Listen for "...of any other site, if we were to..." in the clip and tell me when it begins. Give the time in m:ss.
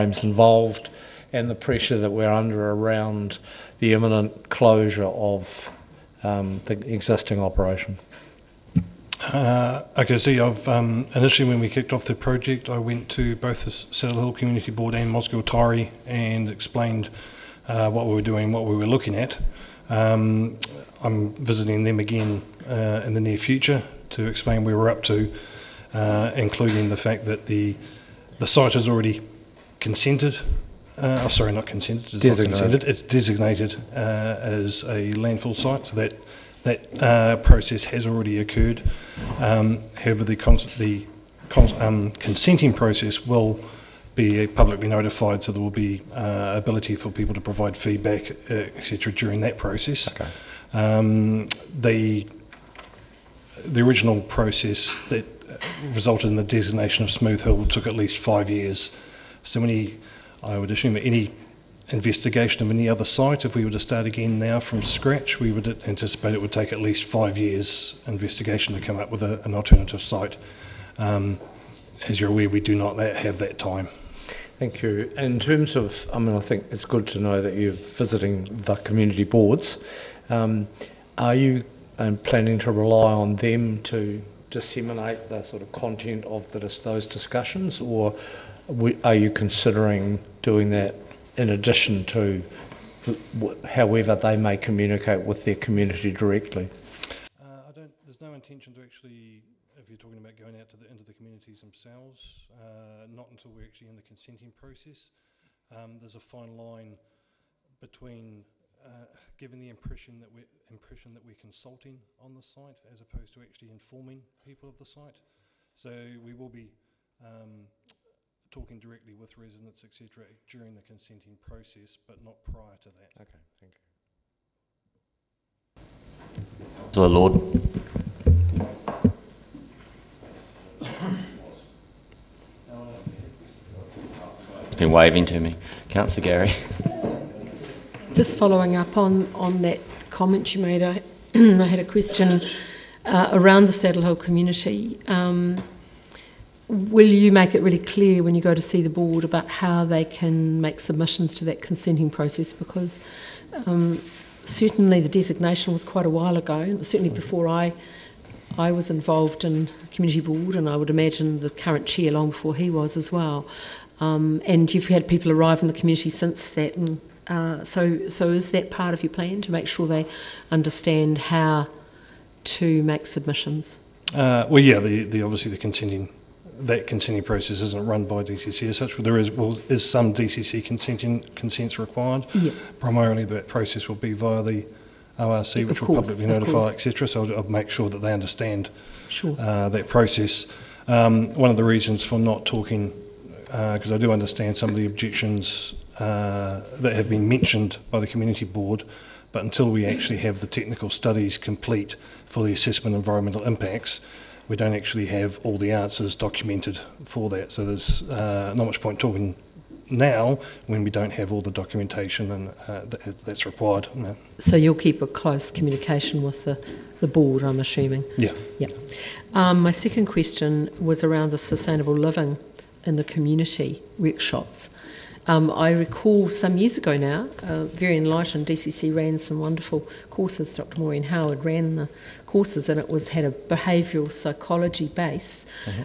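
1:02.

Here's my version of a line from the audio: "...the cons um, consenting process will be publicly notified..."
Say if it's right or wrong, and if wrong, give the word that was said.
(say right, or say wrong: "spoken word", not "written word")
right.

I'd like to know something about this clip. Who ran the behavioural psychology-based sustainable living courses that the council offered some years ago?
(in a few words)
Dr. Maureen Howard.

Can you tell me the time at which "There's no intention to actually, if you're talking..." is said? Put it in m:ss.
1:37.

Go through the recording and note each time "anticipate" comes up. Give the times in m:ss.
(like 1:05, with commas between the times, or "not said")
1:05.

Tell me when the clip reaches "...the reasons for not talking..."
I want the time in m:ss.
3:11.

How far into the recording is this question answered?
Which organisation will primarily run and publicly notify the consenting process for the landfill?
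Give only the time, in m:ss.
3:05.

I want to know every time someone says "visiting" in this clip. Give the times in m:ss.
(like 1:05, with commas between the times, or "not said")
0:21, 1:17.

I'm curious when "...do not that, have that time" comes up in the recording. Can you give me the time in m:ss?
1:12.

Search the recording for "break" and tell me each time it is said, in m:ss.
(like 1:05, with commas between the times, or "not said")
not said.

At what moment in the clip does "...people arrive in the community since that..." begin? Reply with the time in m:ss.
2:45.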